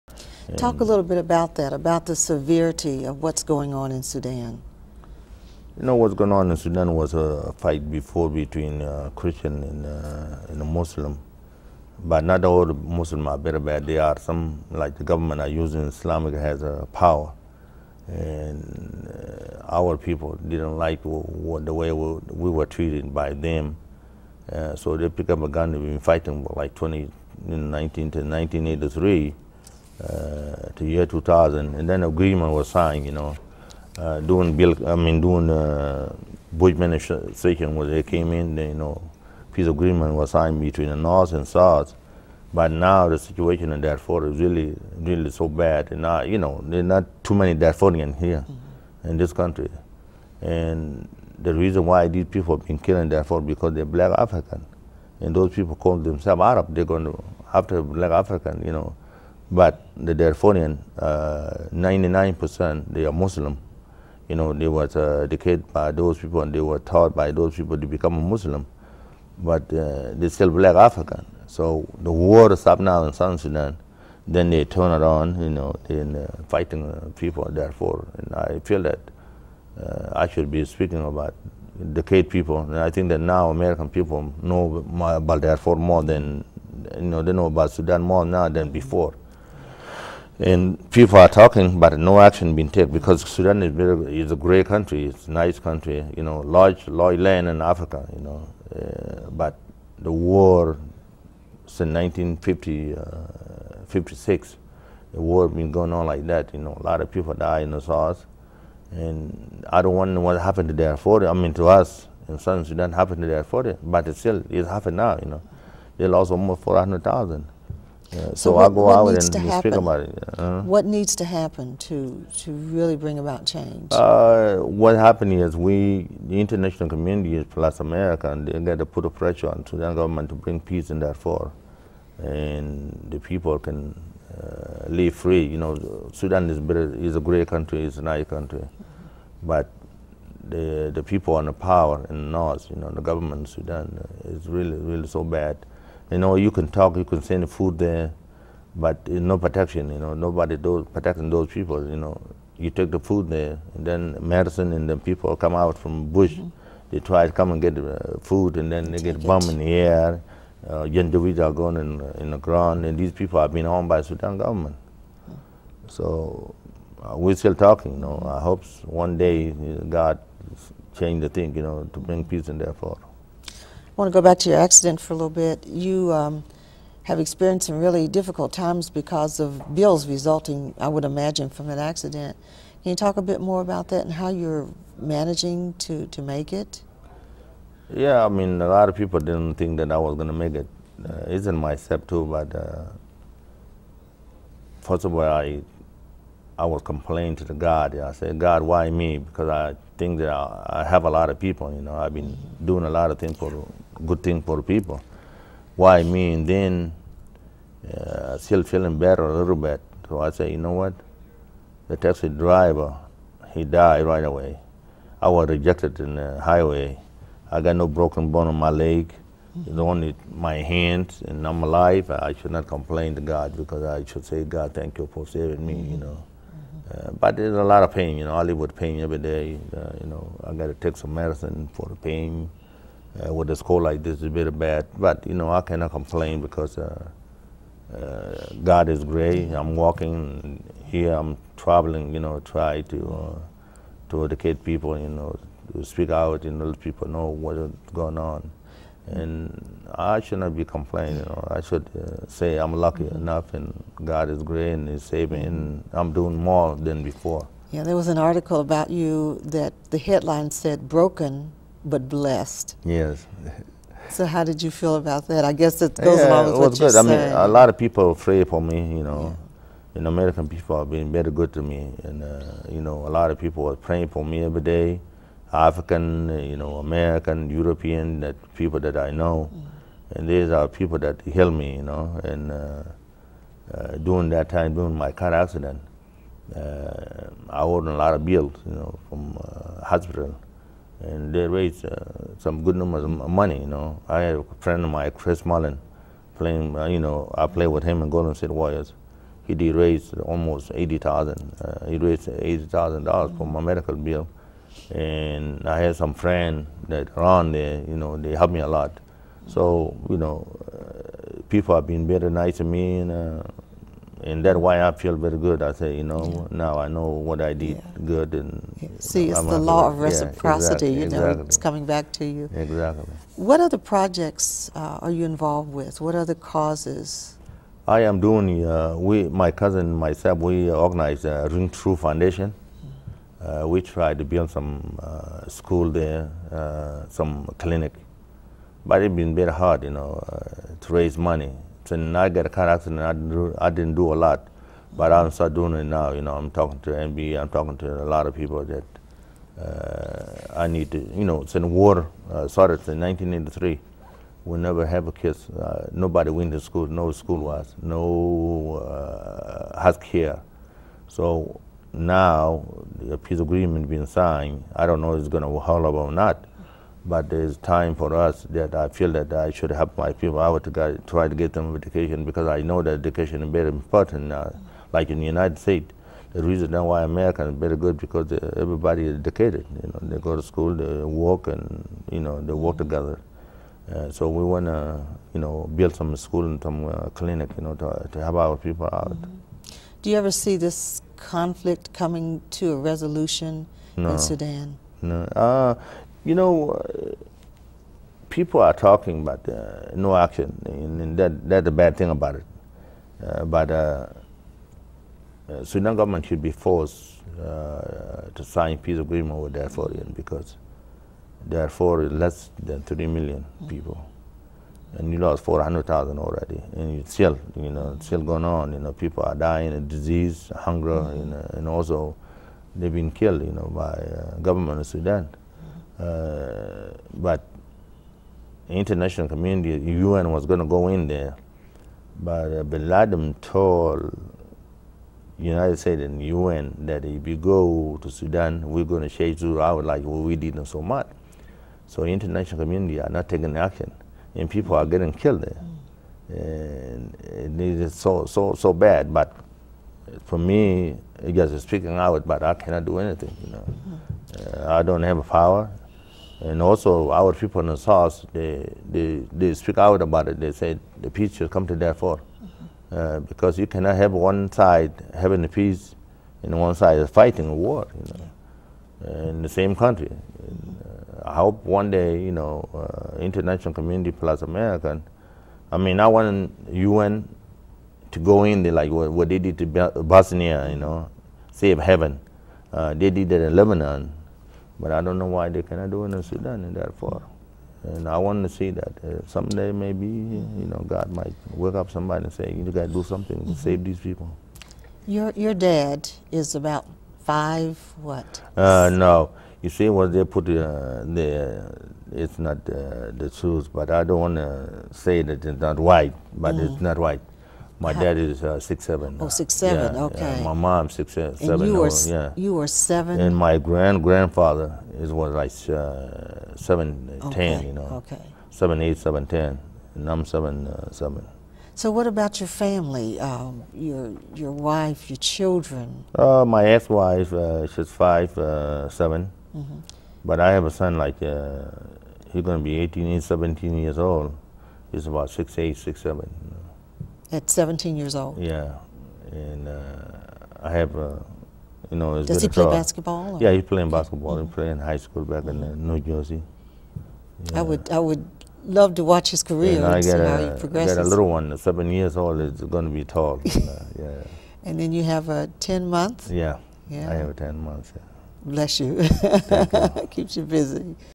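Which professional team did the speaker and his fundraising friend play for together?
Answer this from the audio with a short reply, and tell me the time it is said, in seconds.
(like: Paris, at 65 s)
Golden State Warriors, at 298 s.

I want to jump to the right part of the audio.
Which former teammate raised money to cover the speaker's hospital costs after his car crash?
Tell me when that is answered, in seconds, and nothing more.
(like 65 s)
295 s.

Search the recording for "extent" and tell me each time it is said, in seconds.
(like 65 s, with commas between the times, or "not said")
not said.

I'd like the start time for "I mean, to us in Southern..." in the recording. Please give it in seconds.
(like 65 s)
111 s.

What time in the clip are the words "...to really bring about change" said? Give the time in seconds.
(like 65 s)
122 s.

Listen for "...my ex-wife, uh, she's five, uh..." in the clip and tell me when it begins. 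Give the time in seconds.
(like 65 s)
526 s.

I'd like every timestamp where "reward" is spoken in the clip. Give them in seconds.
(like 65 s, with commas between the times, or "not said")
not said.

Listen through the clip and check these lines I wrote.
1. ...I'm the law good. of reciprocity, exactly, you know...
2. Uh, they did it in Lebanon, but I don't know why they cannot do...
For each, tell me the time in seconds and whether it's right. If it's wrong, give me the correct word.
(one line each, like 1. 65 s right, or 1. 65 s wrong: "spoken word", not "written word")
1. 319 s right
2. 482 s right.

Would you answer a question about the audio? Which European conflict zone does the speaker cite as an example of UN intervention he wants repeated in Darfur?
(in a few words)
Bosnia.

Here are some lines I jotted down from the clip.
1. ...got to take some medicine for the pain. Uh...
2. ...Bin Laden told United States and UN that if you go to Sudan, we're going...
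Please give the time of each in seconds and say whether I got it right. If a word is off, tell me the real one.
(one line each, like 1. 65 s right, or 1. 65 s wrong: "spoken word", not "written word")
1. 230 s right
2. 432 s right.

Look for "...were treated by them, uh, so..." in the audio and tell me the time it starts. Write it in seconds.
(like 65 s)
22 s.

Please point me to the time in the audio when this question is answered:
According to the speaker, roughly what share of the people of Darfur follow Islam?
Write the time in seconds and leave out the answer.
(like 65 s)
61 s.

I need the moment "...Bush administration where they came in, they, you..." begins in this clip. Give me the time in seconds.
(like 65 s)
36 s.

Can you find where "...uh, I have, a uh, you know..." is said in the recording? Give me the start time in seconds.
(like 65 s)
539 s.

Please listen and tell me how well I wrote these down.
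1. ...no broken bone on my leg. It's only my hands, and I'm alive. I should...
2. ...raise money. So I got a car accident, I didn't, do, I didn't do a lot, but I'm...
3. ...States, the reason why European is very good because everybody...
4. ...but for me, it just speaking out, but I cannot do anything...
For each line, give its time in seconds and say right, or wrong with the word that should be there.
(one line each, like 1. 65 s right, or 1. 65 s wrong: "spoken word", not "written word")
1. 217 s right
2. 340 s right
3. 375 s wrong: "America", not "European"
4. 449 s right.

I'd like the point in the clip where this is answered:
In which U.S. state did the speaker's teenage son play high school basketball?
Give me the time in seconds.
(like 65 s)
545 s.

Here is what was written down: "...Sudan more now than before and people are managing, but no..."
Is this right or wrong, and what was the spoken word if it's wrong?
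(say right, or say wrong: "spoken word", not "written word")
wrong: "talking", not "managing".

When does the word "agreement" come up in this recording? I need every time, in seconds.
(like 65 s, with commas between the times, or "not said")
32 s, 39 s, 363 s, 408 s.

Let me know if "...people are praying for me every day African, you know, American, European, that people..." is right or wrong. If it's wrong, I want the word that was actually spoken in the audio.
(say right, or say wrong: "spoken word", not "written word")
right.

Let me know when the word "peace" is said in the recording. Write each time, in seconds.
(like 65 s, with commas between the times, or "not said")
39 s, 130 s, 172 s, 363 s, 408 s, 461 s, 465 s.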